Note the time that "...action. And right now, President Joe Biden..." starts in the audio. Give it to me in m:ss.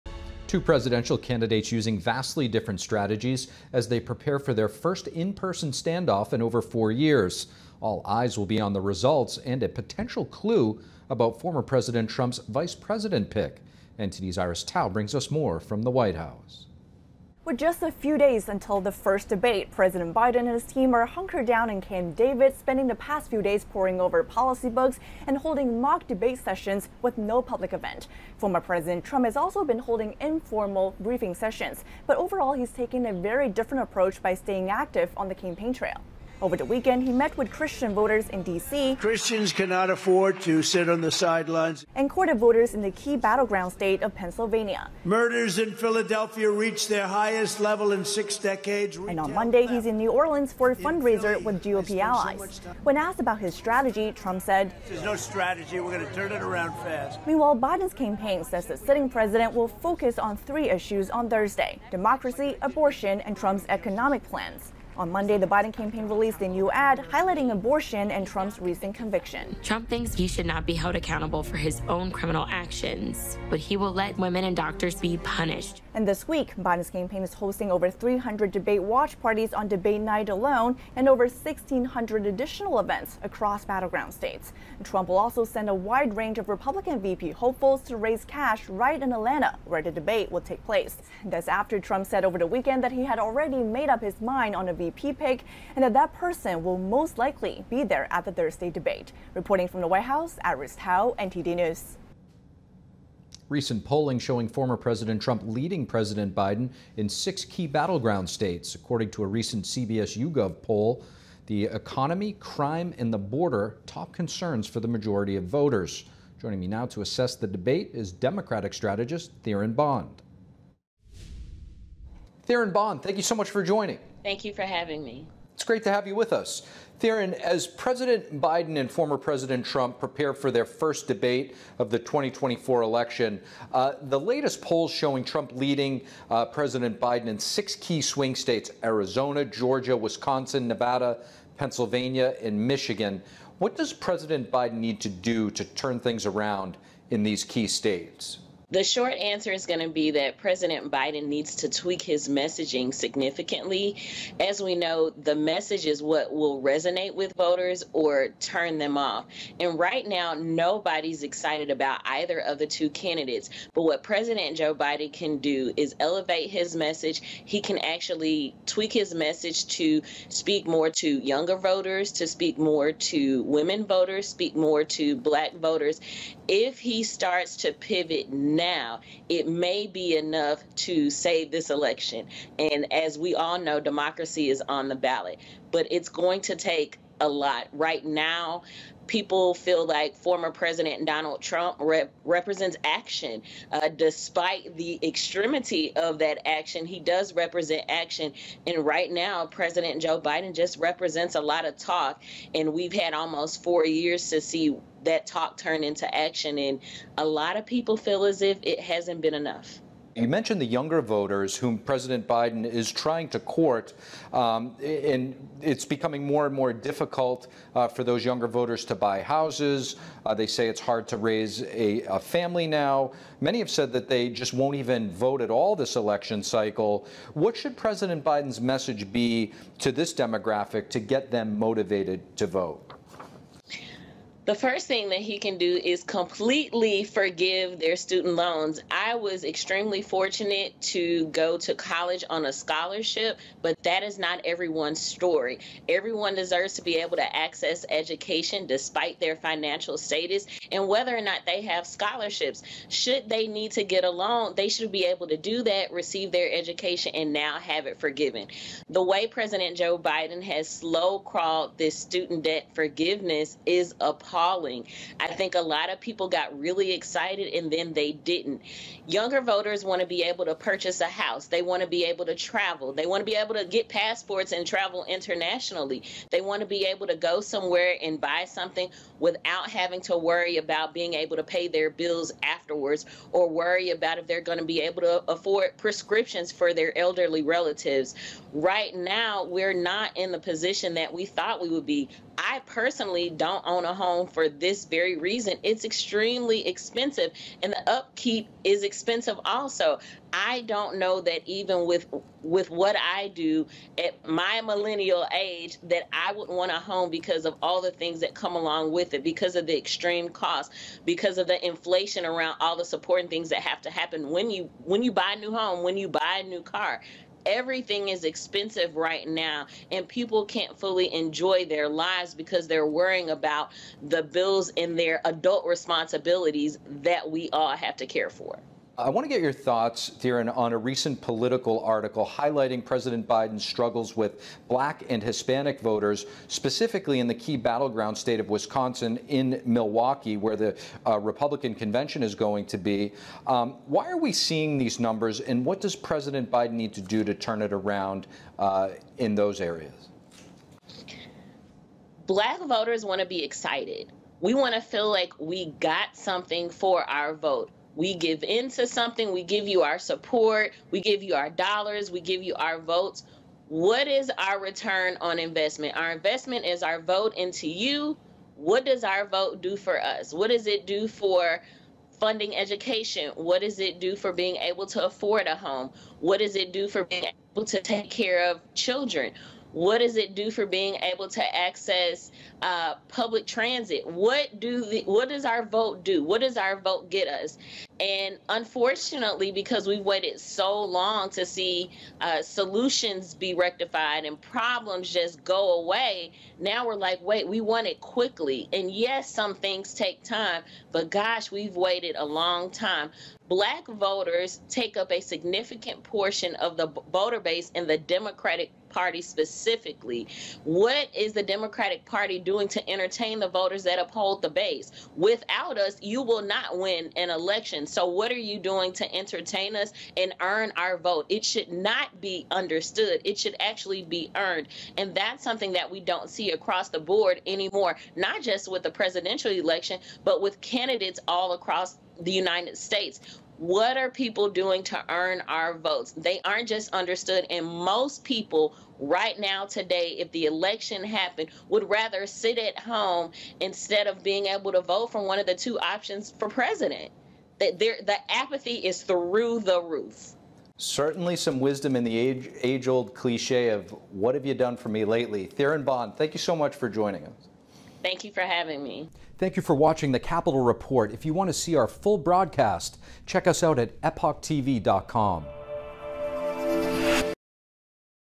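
3:17.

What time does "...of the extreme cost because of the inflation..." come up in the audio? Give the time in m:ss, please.
5:09.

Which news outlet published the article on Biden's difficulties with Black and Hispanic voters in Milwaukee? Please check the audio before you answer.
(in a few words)
Politico.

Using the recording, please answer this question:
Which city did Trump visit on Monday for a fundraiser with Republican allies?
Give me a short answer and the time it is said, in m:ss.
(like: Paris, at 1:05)
New Orleans, at 0:49.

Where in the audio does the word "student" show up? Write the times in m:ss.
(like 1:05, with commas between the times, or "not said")
3:57, 4:21.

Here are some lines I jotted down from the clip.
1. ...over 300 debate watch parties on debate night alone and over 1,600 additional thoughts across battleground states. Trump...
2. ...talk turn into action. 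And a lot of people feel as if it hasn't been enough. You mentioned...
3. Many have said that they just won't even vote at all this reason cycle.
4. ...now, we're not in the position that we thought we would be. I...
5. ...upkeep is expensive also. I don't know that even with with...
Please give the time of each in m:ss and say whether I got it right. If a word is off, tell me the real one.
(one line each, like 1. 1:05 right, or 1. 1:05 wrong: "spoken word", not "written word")
1. 1:17 wrong: "events", not "thoughts"
2. 3:25 right
3. 3:43 wrong: "election", not "reason"
4. 4:48 right
5. 4:57 right.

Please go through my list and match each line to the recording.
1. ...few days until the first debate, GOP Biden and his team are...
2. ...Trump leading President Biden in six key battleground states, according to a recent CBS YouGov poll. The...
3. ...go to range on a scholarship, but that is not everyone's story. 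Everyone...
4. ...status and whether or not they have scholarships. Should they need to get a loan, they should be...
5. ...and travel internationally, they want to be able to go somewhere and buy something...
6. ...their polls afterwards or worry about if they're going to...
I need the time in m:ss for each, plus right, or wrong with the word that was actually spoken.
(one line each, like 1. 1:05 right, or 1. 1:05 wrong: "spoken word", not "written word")
1. 0:17 wrong: "President", not "GOP"
2. 1:45 right
3. 4:01 wrong: "college", not "range"
4. 4:09 right
5. 4:34 right
6. 4:41 wrong: "bills", not "polls".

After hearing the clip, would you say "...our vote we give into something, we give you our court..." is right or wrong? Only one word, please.
wrong.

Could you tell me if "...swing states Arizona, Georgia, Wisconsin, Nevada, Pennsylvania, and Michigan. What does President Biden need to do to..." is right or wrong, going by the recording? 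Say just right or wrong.
right.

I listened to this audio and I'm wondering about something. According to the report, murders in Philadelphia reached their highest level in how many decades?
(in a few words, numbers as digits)
6.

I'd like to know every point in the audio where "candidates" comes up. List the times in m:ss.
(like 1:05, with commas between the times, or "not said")
0:01, 2:42, 7:10.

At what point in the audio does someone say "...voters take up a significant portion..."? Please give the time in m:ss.
6:43.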